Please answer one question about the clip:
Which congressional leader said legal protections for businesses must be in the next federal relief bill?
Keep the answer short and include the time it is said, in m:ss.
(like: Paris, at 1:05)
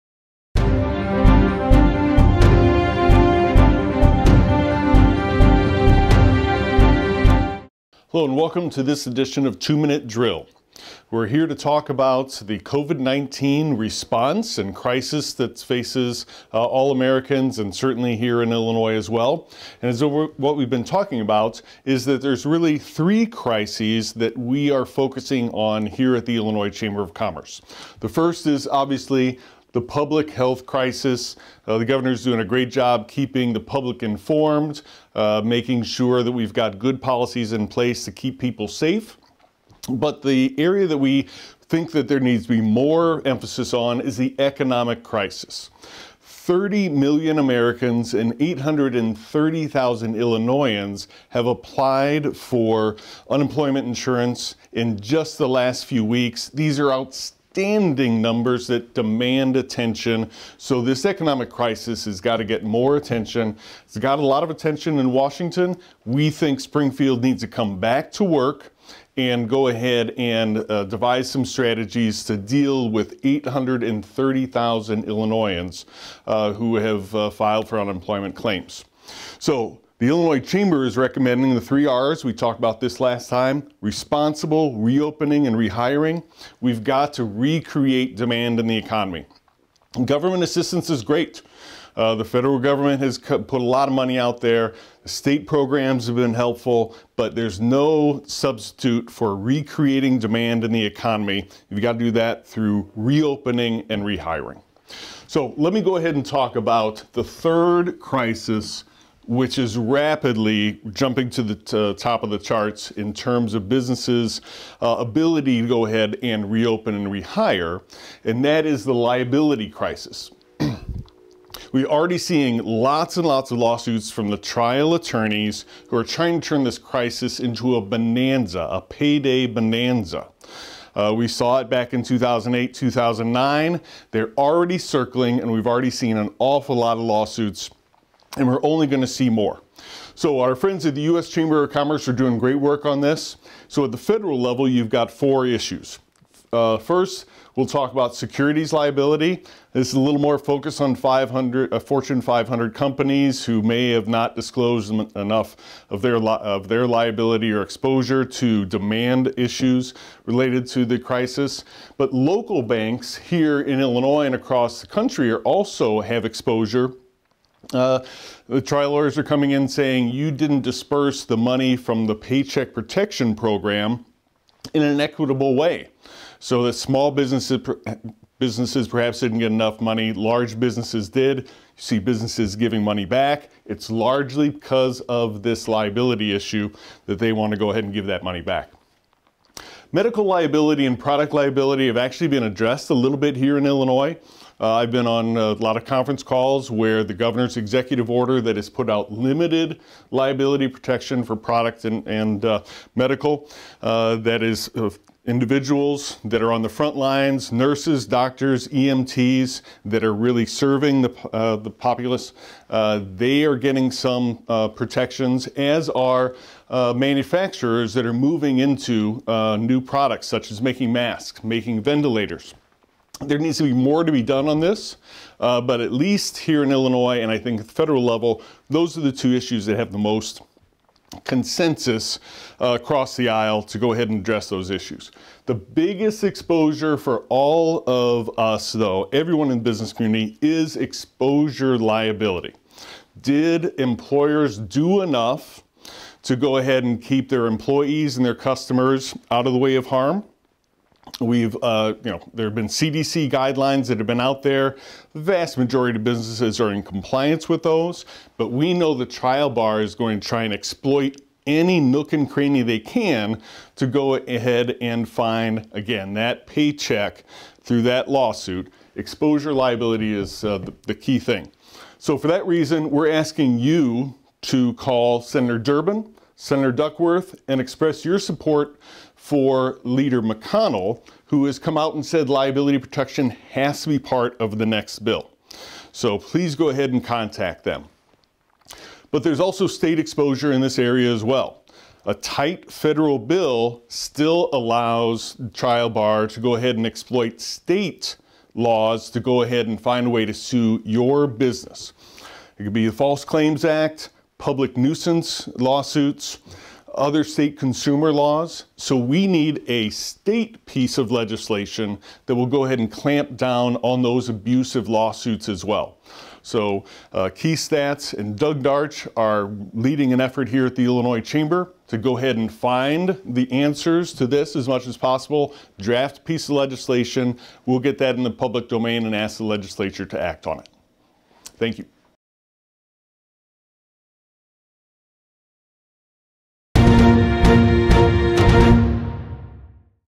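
Leader McConnell, at 4:39.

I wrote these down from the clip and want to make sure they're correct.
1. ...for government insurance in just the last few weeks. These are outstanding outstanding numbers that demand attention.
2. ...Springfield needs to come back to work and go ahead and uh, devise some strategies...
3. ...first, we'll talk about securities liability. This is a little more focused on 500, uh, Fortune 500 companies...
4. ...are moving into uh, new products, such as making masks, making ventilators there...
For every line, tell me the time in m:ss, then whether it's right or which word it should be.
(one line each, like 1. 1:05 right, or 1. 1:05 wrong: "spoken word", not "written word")
1. 0:52 wrong: "unemployment", not "government"
2. 1:06 right
3. 2:26 right
4. 3:38 right.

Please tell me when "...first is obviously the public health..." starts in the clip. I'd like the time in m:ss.
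0:28.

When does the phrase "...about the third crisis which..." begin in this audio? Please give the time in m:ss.
1:46.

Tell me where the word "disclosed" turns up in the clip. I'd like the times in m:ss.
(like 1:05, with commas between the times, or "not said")
2:34.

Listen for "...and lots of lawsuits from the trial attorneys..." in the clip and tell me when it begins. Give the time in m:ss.
2:03.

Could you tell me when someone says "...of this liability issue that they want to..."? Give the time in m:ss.
3:05.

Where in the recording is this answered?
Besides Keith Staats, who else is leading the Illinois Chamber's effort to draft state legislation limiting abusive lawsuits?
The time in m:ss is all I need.
5:18.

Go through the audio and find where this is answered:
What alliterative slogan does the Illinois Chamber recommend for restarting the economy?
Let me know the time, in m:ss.
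1:21.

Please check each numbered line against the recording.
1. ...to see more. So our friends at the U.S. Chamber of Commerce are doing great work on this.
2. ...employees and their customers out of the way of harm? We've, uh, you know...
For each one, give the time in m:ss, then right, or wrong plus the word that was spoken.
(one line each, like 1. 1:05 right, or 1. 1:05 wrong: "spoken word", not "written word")
1. 2:19 right
2. 4:07 right.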